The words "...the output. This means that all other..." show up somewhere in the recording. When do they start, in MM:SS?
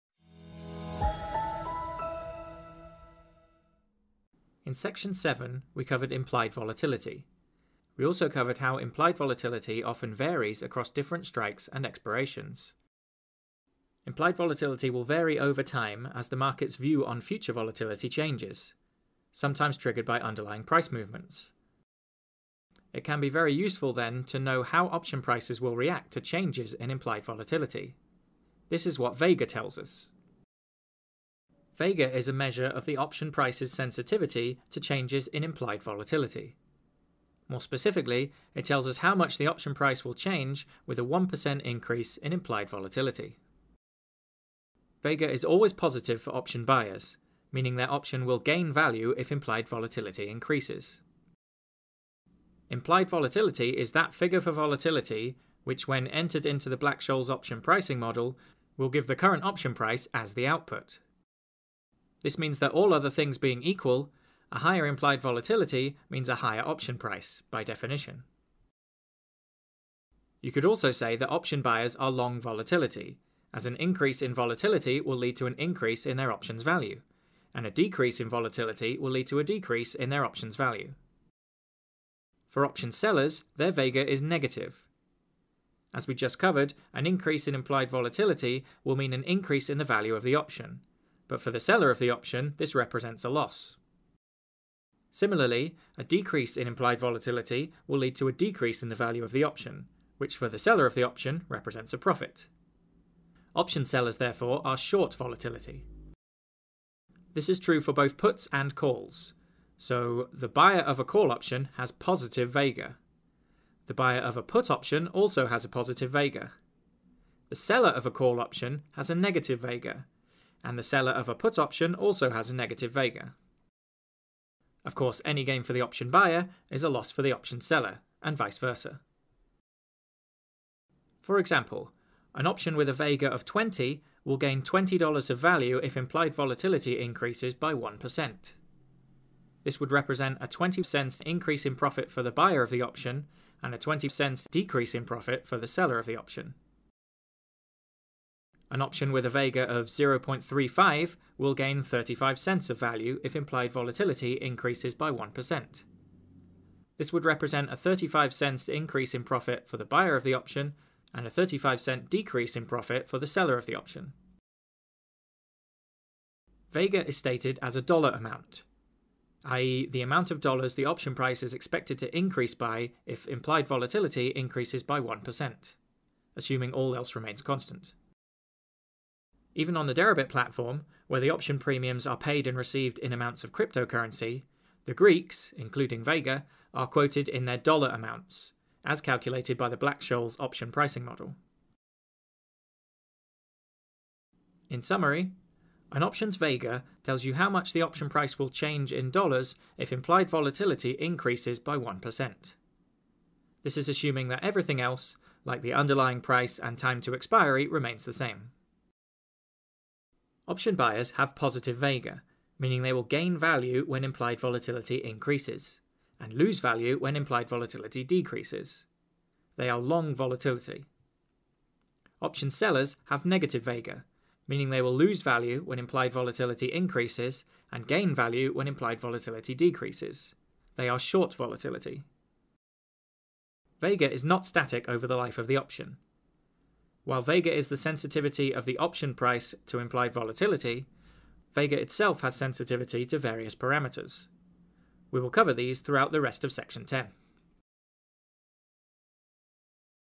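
01:00.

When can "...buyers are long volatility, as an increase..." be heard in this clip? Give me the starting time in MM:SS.
01:11.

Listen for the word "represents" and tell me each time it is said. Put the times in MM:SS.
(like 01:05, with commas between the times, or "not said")
01:32, 01:41, 02:19, 02:37.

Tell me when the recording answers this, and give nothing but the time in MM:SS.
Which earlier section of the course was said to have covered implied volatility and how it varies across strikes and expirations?
00:04.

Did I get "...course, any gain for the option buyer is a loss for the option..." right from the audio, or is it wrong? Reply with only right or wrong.
right.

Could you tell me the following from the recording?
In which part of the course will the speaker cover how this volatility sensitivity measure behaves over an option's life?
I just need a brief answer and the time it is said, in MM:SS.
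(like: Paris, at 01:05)
Section 10, at 04:06.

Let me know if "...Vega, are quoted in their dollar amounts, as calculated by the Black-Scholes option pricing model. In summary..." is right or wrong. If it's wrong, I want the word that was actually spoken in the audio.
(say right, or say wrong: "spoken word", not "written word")
right.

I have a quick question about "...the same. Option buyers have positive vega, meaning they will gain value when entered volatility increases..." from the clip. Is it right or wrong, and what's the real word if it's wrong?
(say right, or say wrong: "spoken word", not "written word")
wrong: "implied", not "entered".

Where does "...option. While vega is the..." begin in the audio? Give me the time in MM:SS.
03:55.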